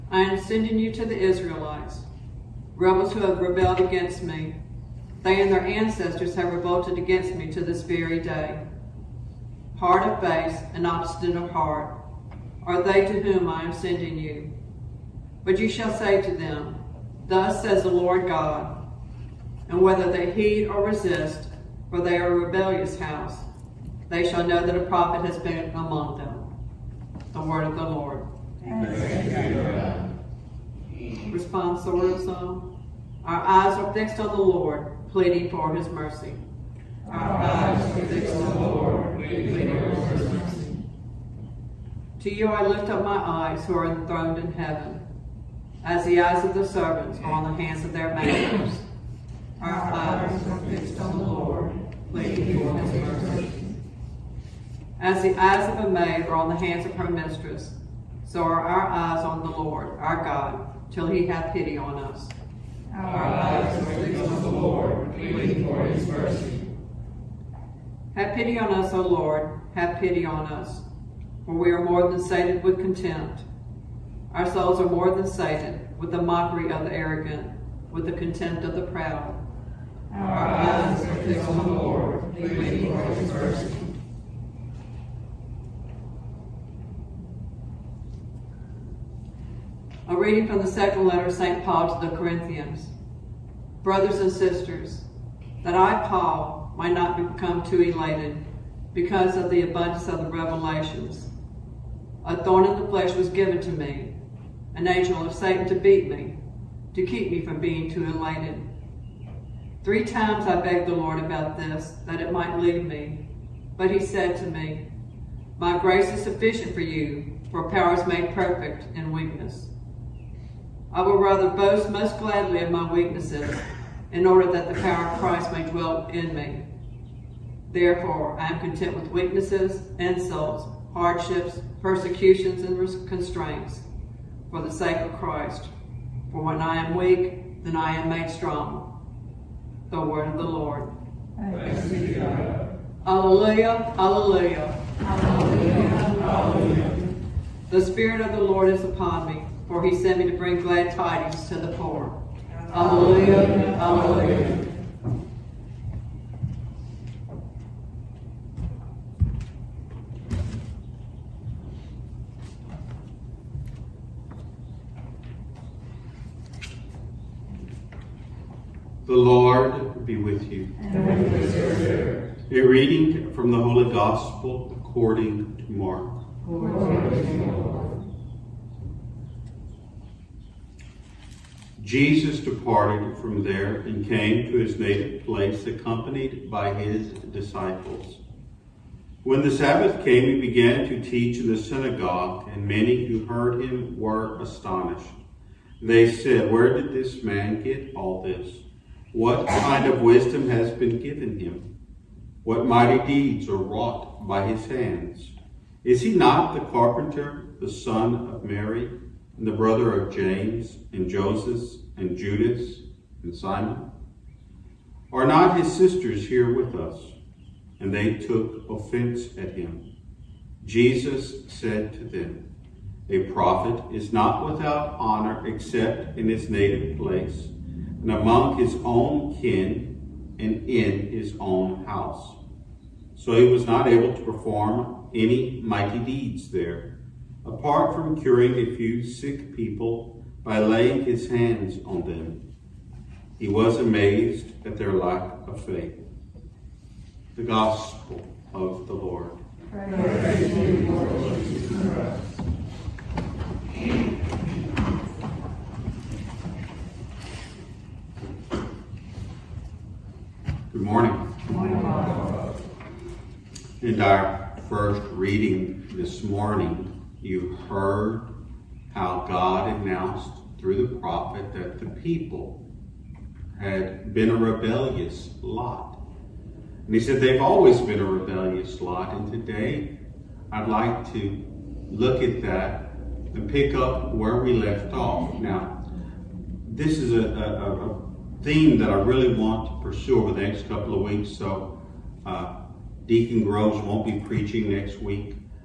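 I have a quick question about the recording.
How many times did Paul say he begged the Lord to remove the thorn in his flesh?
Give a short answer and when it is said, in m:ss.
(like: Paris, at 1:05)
3, at 1:49.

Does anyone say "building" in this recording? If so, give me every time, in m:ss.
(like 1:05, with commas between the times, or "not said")
not said.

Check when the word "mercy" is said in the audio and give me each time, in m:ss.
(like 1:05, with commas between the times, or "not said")
0:35, 0:40, 0:53, 1:06, 1:23.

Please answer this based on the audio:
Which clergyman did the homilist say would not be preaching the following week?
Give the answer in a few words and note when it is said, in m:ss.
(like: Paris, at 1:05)
Deacon Groves, at 4:53.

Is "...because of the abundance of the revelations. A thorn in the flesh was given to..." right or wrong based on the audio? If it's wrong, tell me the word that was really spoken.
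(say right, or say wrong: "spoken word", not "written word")
right.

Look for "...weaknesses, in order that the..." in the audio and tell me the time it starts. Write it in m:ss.
2:02.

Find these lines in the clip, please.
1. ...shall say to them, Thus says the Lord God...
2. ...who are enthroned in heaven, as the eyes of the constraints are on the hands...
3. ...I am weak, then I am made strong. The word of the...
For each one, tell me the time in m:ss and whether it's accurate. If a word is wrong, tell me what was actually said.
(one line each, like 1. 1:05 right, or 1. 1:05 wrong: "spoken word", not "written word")
1. 0:15 right
2. 0:43 wrong: "servants", not "constraints"
3. 2:16 right.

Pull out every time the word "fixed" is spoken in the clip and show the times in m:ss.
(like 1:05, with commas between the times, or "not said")
0:33, 0:38, 0:50, 1:03, 1:21.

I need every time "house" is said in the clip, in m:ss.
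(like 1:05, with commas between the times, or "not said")
0:22, 3:51.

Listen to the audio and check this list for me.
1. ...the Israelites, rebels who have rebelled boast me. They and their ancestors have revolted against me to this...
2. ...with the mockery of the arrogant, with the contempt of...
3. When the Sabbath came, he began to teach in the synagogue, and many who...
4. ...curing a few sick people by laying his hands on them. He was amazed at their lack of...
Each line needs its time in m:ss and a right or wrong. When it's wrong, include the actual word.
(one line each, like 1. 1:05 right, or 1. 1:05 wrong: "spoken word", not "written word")
1. 0:01 wrong: "against", not "boast"
2. 1:15 right
3. 3:09 right
4. 3:58 right.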